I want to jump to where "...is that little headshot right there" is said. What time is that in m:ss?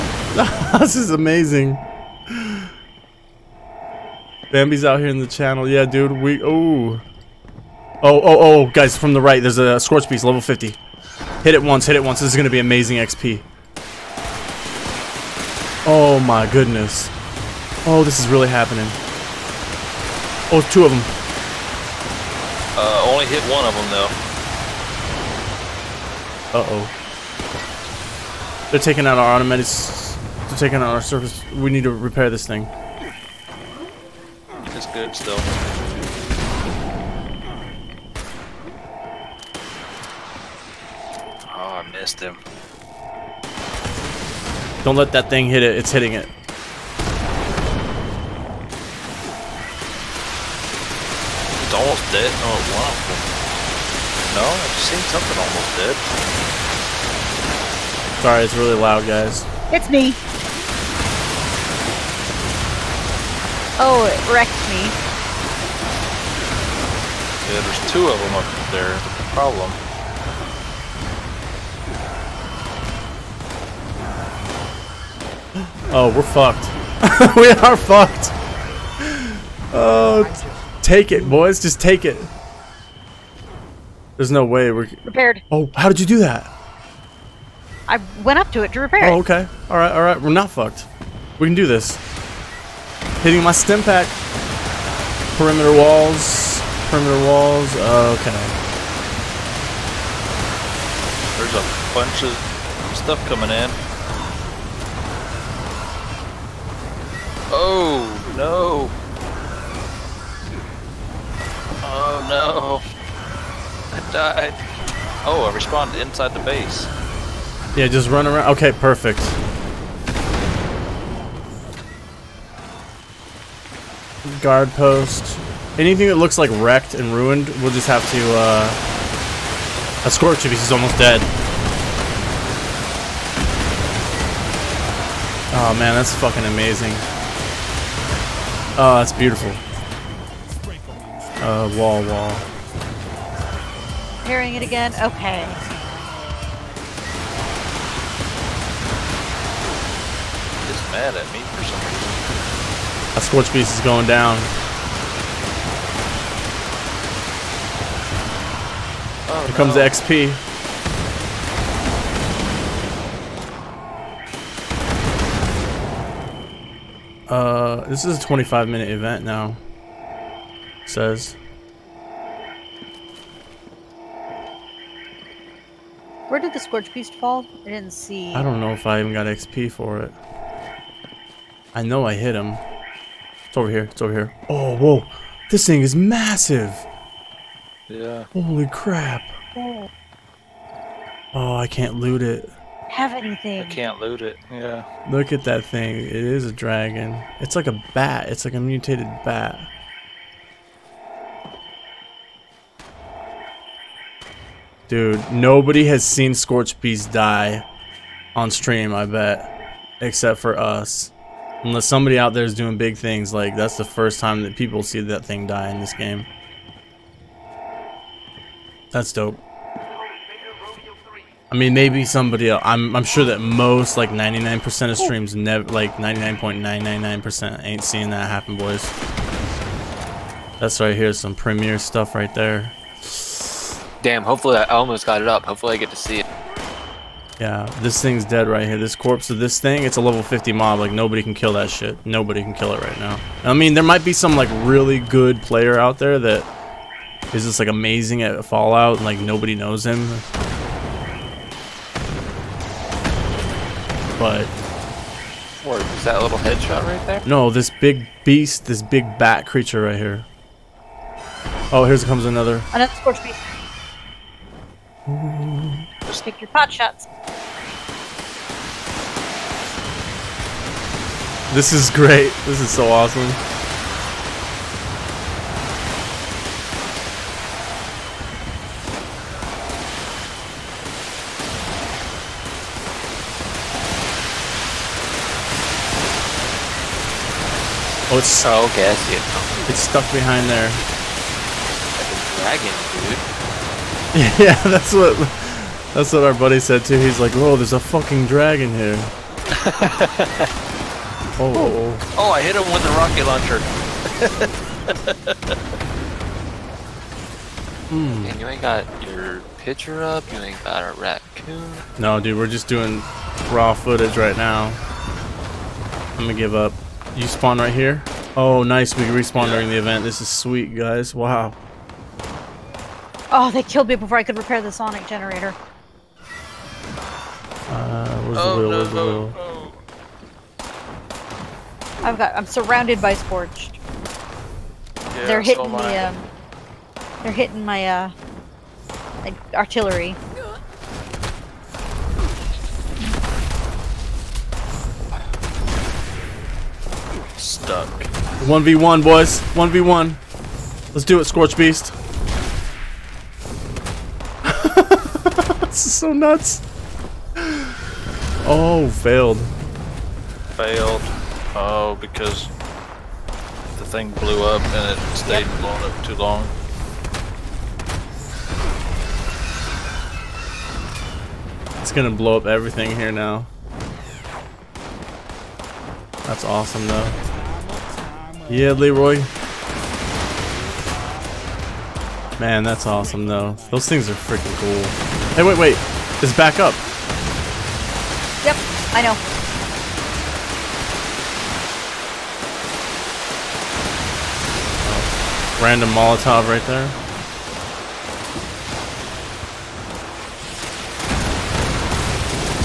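4:15.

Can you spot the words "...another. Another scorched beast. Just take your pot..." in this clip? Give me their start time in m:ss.
4:22.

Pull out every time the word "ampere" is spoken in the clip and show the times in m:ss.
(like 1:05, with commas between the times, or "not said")
not said.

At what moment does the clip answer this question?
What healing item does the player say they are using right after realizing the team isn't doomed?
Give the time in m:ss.
1:33.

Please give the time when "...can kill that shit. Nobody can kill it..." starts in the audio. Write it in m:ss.
4:01.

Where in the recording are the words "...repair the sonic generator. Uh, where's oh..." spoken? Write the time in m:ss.
5:24.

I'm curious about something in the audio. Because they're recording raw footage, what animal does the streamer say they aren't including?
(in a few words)
raccoon.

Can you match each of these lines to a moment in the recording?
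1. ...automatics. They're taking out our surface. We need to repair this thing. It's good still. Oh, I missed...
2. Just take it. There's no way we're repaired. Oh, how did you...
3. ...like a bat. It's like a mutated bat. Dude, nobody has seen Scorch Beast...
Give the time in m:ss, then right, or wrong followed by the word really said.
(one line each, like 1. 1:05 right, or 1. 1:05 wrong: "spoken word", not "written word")
1. 0:29 right
2. 1:21 right
3. 3:17 right.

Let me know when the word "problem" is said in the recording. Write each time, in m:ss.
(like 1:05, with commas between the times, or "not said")
1:09.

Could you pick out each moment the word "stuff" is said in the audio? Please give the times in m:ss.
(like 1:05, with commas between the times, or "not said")
1:42, 3:51.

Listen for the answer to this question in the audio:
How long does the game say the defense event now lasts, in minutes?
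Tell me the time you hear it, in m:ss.
2:48.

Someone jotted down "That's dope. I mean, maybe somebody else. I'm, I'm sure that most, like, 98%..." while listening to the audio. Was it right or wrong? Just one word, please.
wrong.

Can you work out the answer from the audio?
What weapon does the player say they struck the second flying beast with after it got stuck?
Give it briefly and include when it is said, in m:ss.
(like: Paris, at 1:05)
rocket launcher, at 5:02.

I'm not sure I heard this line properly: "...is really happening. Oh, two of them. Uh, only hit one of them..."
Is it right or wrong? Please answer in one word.
right.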